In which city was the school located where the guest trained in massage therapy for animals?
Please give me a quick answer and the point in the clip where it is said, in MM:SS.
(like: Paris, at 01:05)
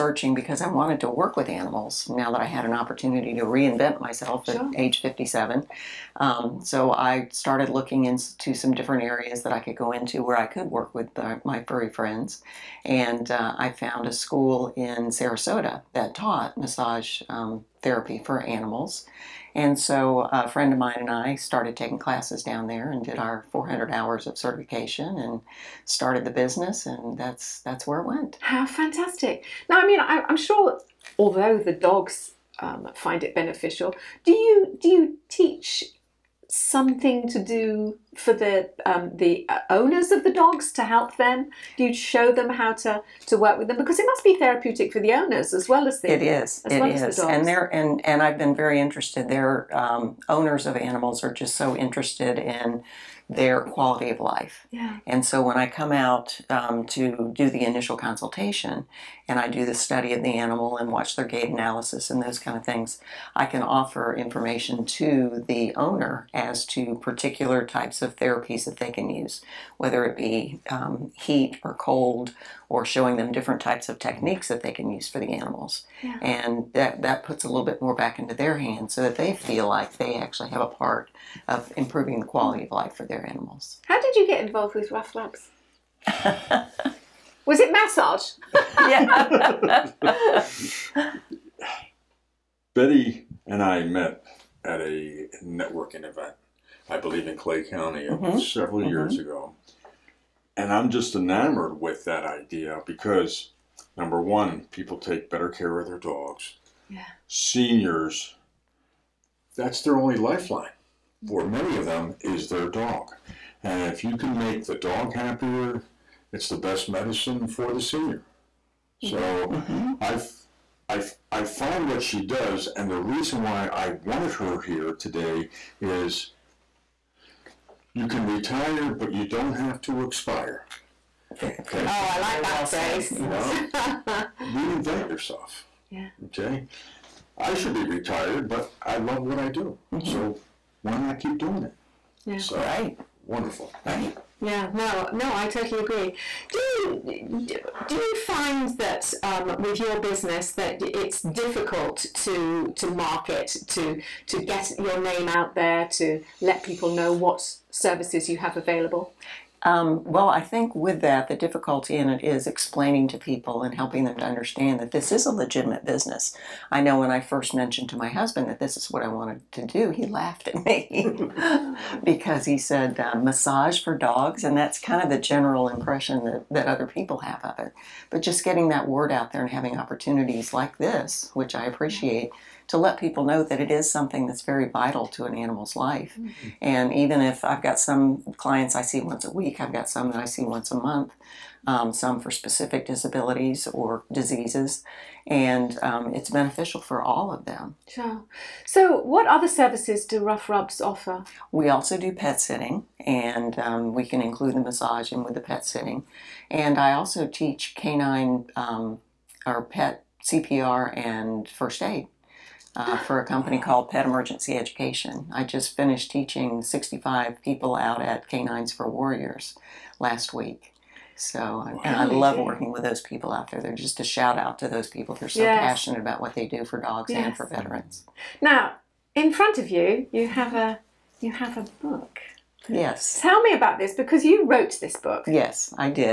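Sarasota, at 00:15.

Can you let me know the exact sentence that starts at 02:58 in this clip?
But just getting that word out there and having opportunities like this, which I mm-hmm.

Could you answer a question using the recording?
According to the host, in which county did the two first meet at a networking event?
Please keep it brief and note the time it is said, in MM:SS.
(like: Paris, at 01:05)
Clay County, at 01:37.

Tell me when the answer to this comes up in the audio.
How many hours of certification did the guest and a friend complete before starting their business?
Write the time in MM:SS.
00:23.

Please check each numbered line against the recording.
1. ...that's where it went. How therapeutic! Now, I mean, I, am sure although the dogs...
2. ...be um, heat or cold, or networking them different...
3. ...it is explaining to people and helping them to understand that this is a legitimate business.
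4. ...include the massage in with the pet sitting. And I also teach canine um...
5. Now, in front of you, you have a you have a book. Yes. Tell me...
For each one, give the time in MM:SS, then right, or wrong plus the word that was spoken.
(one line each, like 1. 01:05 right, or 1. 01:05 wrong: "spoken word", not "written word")
1. 00:27 wrong: "fantastic", not "therapeutic"
2. 01:10 wrong: "showing", not "networking"
3. 02:42 right
4. 03:24 right
5. 03:48 right.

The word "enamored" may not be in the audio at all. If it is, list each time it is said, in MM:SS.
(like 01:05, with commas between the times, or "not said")
01:41.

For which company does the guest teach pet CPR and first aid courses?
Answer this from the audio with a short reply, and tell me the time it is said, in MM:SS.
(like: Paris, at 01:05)
Pet Emergency Education, at 03:33.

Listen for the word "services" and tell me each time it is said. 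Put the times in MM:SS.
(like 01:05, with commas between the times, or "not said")
02:37, 03:19.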